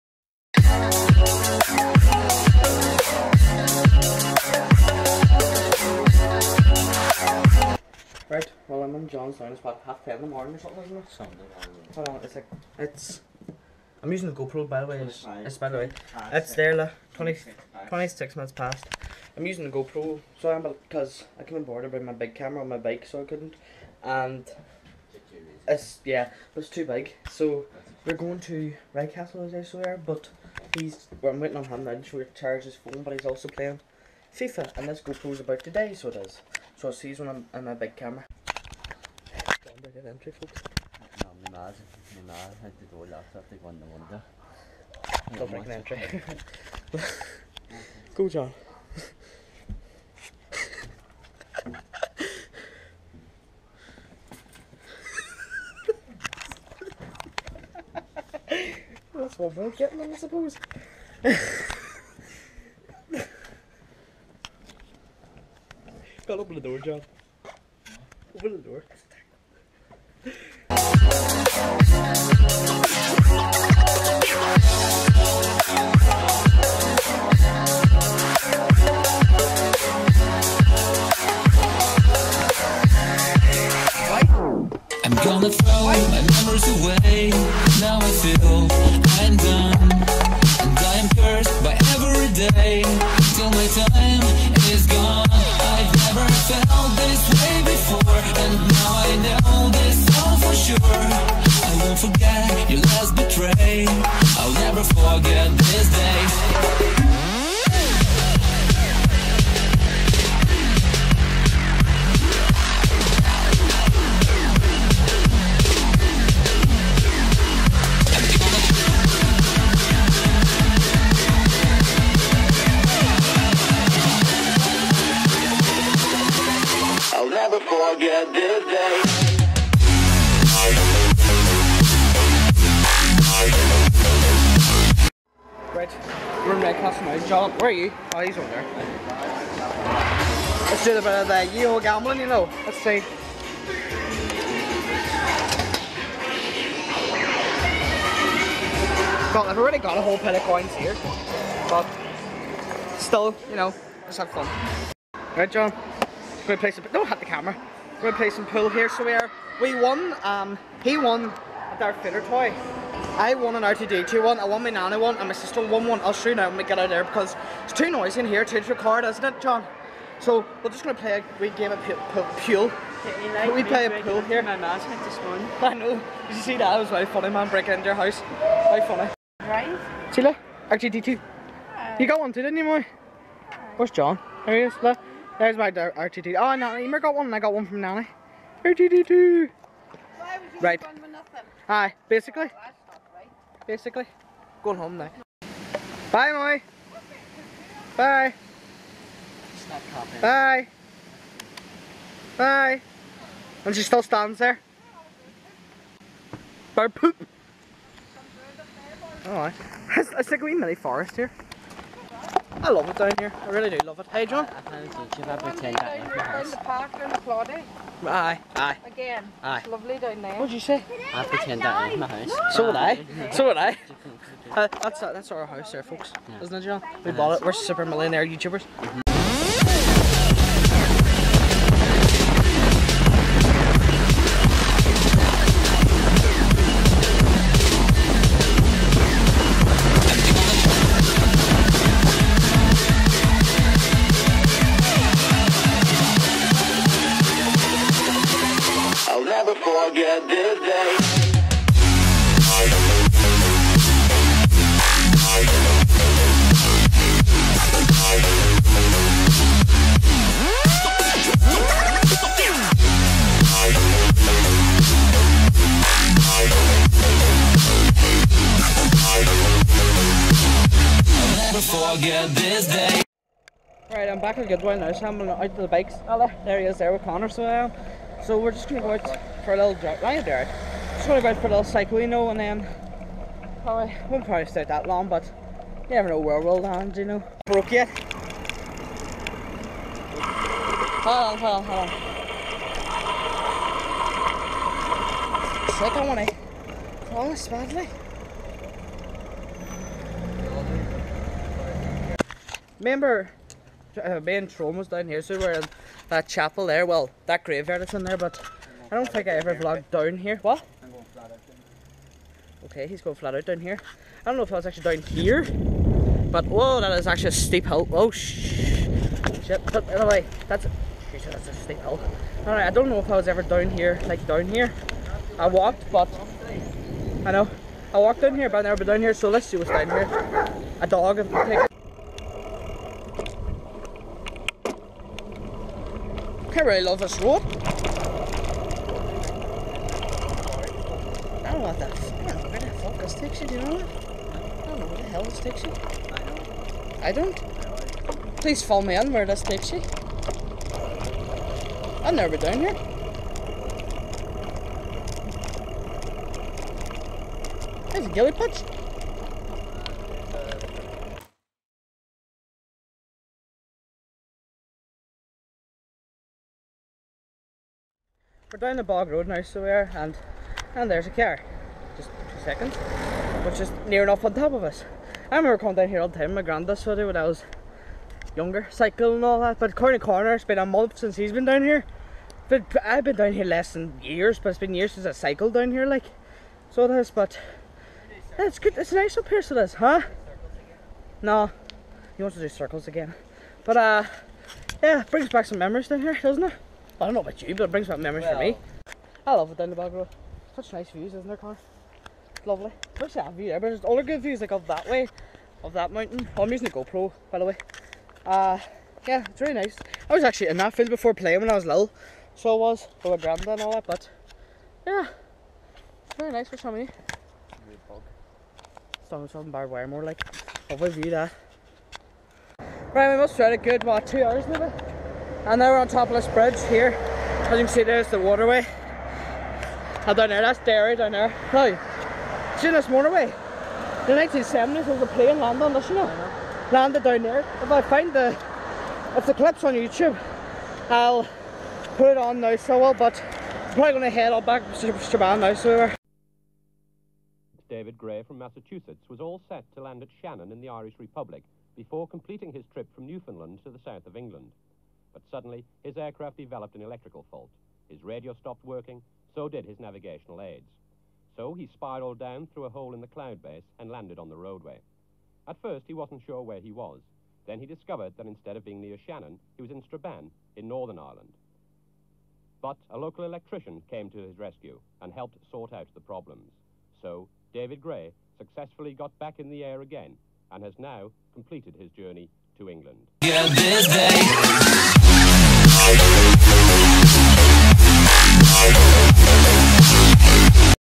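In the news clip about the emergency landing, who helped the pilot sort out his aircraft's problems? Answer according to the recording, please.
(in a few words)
A local electrician.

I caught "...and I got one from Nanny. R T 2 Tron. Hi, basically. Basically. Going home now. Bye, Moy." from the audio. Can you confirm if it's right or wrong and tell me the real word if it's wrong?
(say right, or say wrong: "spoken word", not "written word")
wrong: "Right", not "Tron".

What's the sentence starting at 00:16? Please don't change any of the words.
It's there, look, 20, 26 minutes past.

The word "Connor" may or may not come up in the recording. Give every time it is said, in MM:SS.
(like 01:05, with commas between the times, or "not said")
04:37, 06:41.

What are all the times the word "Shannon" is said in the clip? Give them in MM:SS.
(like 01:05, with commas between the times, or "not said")
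07:30, 07:49.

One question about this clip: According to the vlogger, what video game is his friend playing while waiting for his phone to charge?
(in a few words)
FIFA.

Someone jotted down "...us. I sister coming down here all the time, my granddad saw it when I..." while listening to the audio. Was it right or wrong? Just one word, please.
wrong.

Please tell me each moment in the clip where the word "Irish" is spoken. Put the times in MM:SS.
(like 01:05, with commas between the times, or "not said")
07:30.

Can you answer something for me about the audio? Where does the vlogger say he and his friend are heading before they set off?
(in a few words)
Redcastle.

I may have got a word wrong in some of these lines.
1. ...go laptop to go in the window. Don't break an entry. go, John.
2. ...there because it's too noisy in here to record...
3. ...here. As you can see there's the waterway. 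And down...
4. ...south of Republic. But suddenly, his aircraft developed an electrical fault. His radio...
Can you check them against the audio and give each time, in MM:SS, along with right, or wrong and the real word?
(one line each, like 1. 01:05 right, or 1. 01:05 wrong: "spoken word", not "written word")
1. 00:42 right
2. 02:46 right
3. 07:06 right
4. 07:33 wrong: "England", not "Republic".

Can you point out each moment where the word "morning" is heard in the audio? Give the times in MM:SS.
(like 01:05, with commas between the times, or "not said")
00:10, 02:55.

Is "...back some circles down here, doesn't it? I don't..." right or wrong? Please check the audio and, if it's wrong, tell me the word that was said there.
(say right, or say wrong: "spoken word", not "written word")
wrong: "memories", not "circles".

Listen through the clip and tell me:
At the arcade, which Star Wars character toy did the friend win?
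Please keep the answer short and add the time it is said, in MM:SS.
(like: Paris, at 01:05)
Darth Vader, at 02:41.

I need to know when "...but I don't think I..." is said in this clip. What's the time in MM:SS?
05:08.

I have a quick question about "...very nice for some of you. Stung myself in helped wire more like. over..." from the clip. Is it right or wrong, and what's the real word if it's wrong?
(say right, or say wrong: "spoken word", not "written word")
wrong: "barbed", not "helped".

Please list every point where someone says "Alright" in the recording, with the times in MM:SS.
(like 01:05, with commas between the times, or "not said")
03:29, 05:22.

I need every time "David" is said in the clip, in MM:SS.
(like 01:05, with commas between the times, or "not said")
07:27, 07:57.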